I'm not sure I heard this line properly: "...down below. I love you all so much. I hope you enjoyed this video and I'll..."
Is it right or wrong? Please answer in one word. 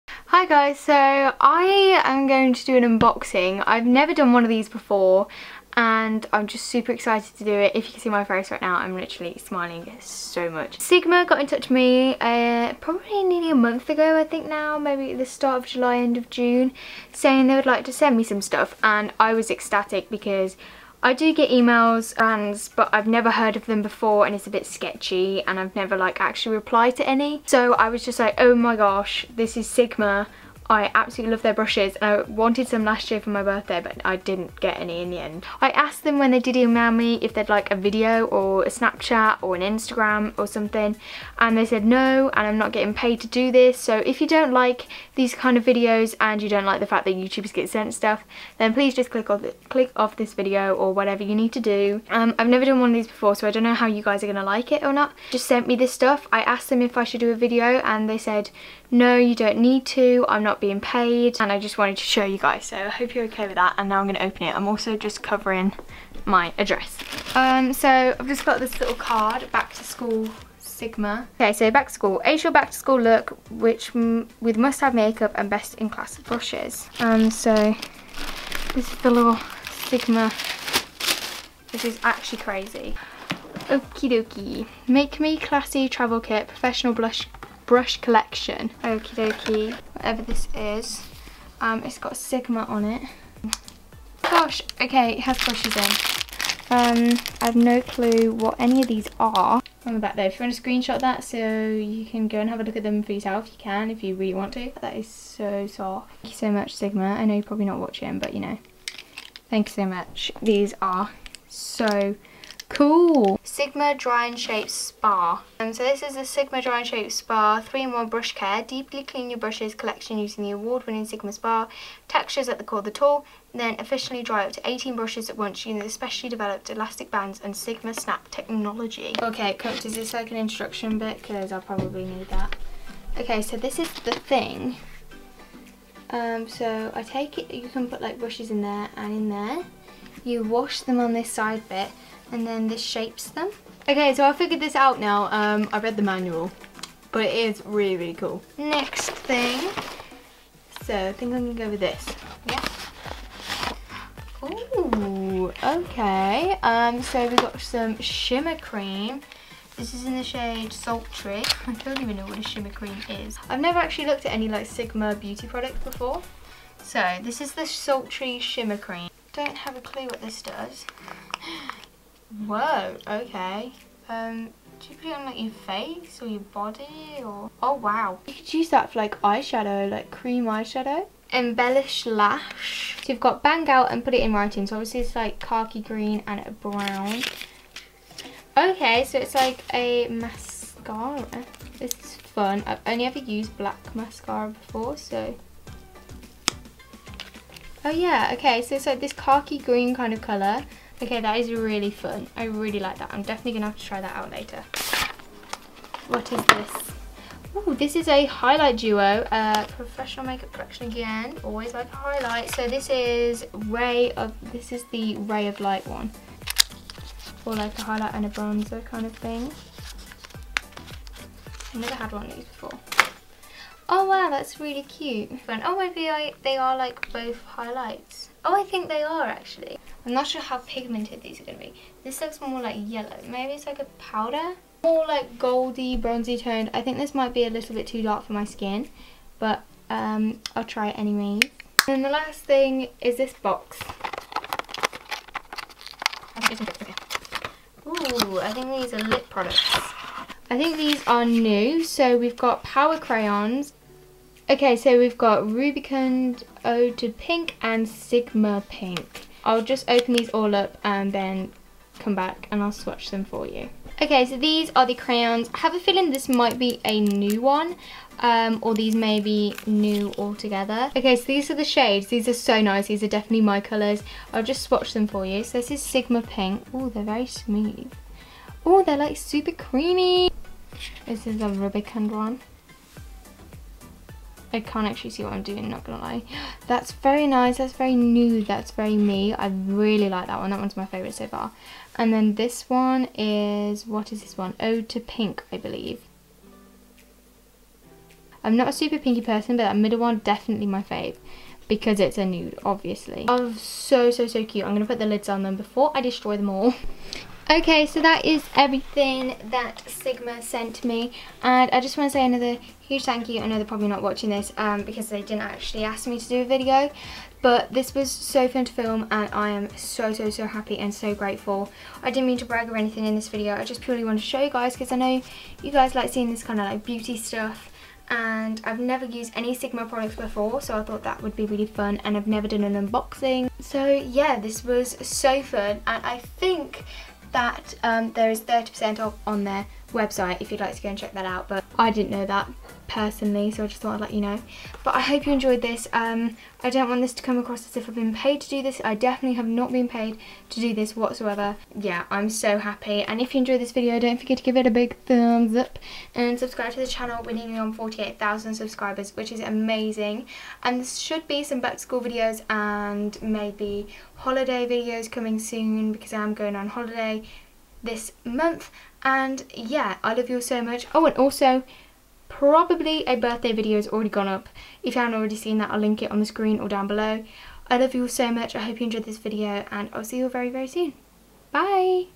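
right.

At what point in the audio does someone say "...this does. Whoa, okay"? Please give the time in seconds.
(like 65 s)
170 s.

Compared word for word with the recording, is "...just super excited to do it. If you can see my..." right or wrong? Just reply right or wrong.
right.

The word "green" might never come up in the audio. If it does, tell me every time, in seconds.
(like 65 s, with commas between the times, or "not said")
185 s, 199 s.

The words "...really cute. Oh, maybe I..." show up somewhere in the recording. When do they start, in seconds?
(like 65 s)
224 s.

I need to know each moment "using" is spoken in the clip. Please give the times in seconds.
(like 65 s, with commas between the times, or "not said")
120 s, 125 s.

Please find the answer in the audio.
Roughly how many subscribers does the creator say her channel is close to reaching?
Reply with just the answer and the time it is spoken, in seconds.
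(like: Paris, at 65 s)
48,000, at 357 s.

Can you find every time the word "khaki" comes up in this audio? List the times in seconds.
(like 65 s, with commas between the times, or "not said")
185 s, 199 s.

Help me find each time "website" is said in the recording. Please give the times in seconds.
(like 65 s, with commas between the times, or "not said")
339 s.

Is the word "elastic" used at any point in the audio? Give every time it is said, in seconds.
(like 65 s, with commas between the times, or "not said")
126 s.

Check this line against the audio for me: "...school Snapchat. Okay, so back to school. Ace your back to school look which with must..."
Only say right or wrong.
wrong.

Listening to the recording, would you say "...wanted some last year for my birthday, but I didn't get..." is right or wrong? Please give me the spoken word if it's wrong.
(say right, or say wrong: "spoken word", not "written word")
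right.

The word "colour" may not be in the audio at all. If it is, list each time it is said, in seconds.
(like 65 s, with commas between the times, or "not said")
200 s, 273 s.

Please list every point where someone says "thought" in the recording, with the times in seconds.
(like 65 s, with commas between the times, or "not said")
330 s, 343 s.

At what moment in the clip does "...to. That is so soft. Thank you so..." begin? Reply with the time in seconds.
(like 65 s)
104 s.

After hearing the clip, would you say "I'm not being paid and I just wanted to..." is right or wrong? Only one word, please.
right.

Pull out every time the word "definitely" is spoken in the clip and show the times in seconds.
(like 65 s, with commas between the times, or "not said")
203 s, 273 s, 300 s, 348 s.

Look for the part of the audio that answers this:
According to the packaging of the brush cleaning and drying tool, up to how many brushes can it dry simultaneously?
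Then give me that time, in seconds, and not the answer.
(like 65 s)
124 s.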